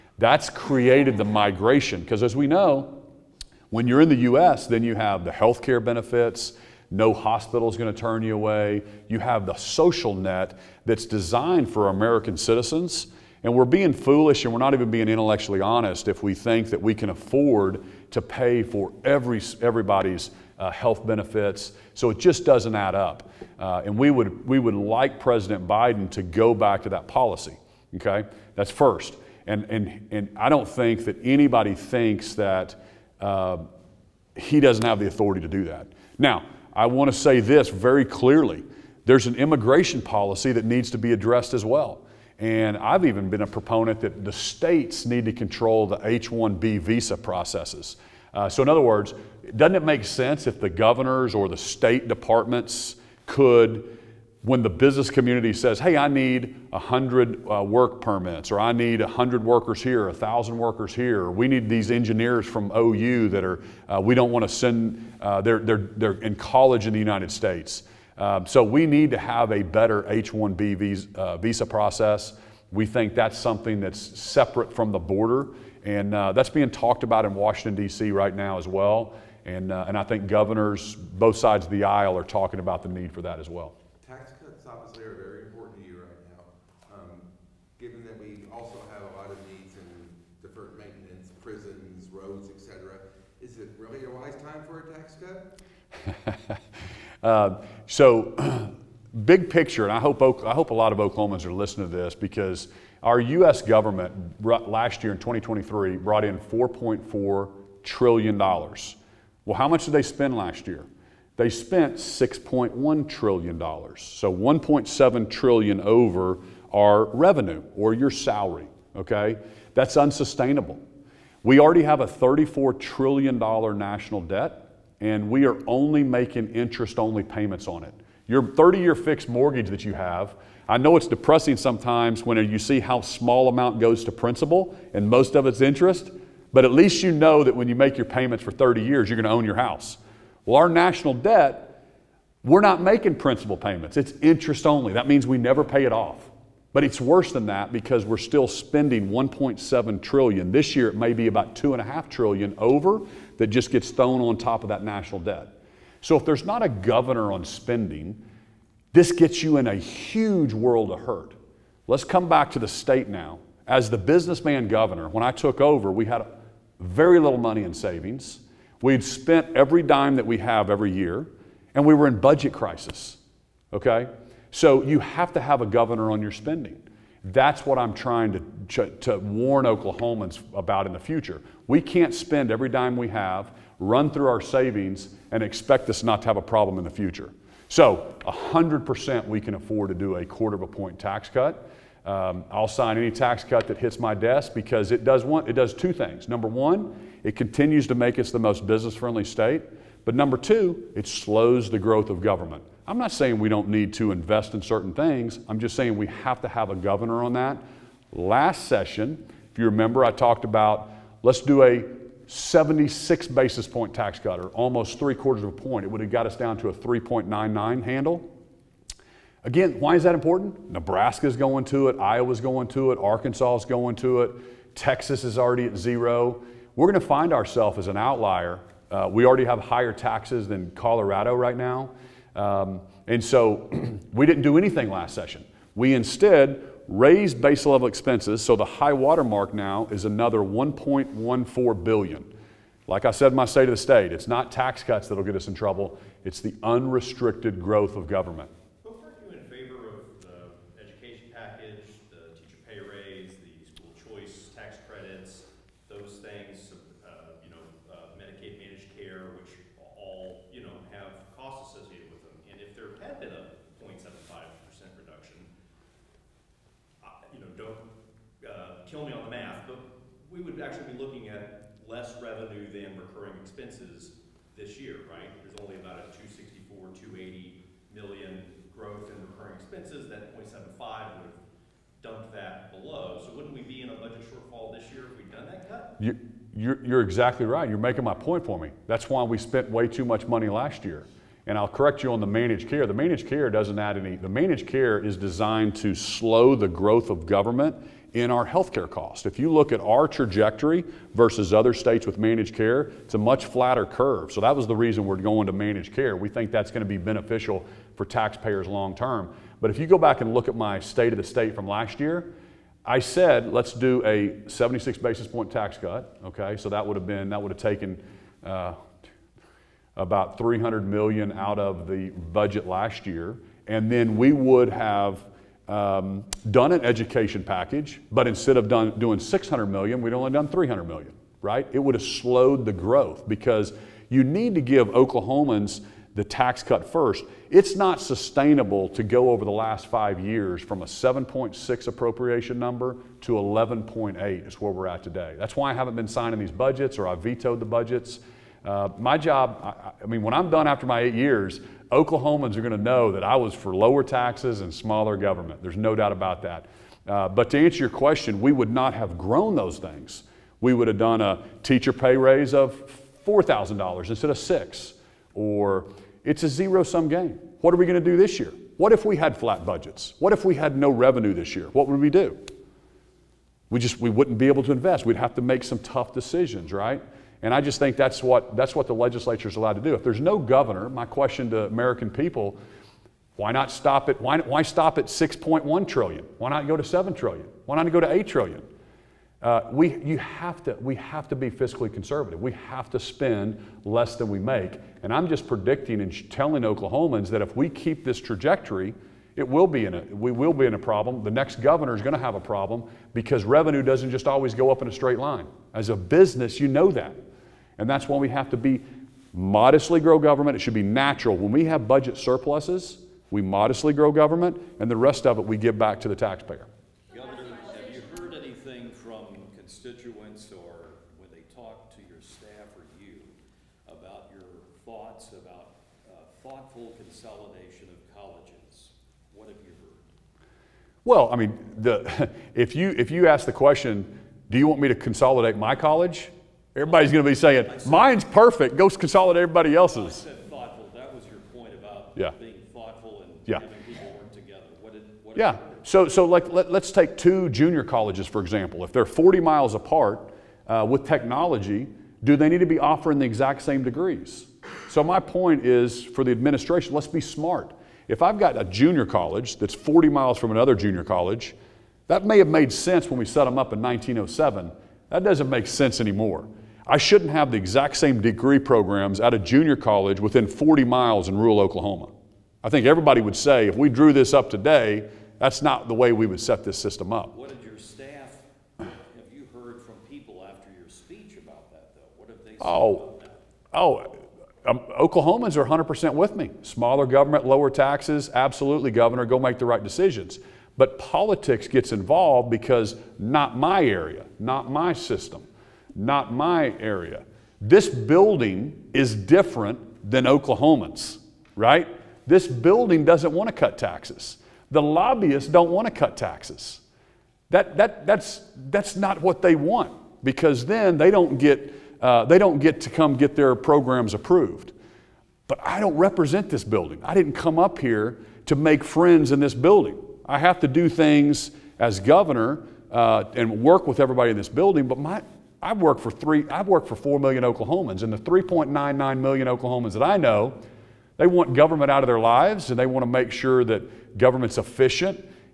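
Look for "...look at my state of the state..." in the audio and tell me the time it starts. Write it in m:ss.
5:10.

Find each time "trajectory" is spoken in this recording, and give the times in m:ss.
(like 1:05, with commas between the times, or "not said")
5:00, 6:38.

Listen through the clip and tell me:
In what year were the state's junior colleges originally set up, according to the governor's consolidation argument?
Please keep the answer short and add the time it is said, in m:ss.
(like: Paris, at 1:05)
1907, at 7:43.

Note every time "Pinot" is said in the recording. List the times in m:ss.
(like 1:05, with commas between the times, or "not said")
not said.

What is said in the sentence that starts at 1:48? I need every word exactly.
Well, how much did they spend last year?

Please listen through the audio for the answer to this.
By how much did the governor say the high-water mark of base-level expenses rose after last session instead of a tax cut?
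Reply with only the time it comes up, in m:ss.
4:00.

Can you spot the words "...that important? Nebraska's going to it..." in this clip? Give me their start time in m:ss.
3:40.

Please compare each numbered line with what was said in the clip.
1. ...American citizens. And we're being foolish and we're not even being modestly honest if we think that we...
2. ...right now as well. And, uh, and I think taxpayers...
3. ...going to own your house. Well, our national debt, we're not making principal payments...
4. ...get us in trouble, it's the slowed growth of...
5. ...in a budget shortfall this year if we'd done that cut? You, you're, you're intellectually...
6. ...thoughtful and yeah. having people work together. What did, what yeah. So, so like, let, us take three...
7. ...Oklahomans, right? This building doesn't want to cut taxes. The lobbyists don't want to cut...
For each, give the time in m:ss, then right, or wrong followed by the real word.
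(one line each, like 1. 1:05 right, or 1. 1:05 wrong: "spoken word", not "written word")
1. 0:11 wrong: "intellectually", not "modestly"
2. 1:18 wrong: "governors", not "taxpayers"
3. 2:19 right
4. 4:05 wrong: "unrestricted", not "slowed"
5. 4:43 wrong: "exactly", not "intellectually"
6. 7:22 wrong: "two", not "three"
7. 8:20 right.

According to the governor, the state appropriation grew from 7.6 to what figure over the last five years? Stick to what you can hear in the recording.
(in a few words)
11.8.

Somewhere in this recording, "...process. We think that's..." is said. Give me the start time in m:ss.
1:11.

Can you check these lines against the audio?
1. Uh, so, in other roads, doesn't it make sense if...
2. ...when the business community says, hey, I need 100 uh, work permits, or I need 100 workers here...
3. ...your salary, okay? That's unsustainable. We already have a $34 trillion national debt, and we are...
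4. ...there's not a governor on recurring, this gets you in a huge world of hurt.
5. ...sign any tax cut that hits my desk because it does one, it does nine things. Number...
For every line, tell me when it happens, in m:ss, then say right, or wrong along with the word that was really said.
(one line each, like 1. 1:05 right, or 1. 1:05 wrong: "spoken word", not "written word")
1. 0:48 wrong: "words", not "roads"
2. 0:54 right
3. 1:57 right
4. 2:36 wrong: "spending", not "recurring"
5. 3:12 wrong: "two", not "nine".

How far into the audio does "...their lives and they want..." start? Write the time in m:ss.
8:52.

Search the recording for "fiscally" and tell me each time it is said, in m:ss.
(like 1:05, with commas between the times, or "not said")
6:31.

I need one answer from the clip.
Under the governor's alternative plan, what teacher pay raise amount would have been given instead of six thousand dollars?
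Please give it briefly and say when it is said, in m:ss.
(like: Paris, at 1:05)
$4,000, at 6:03.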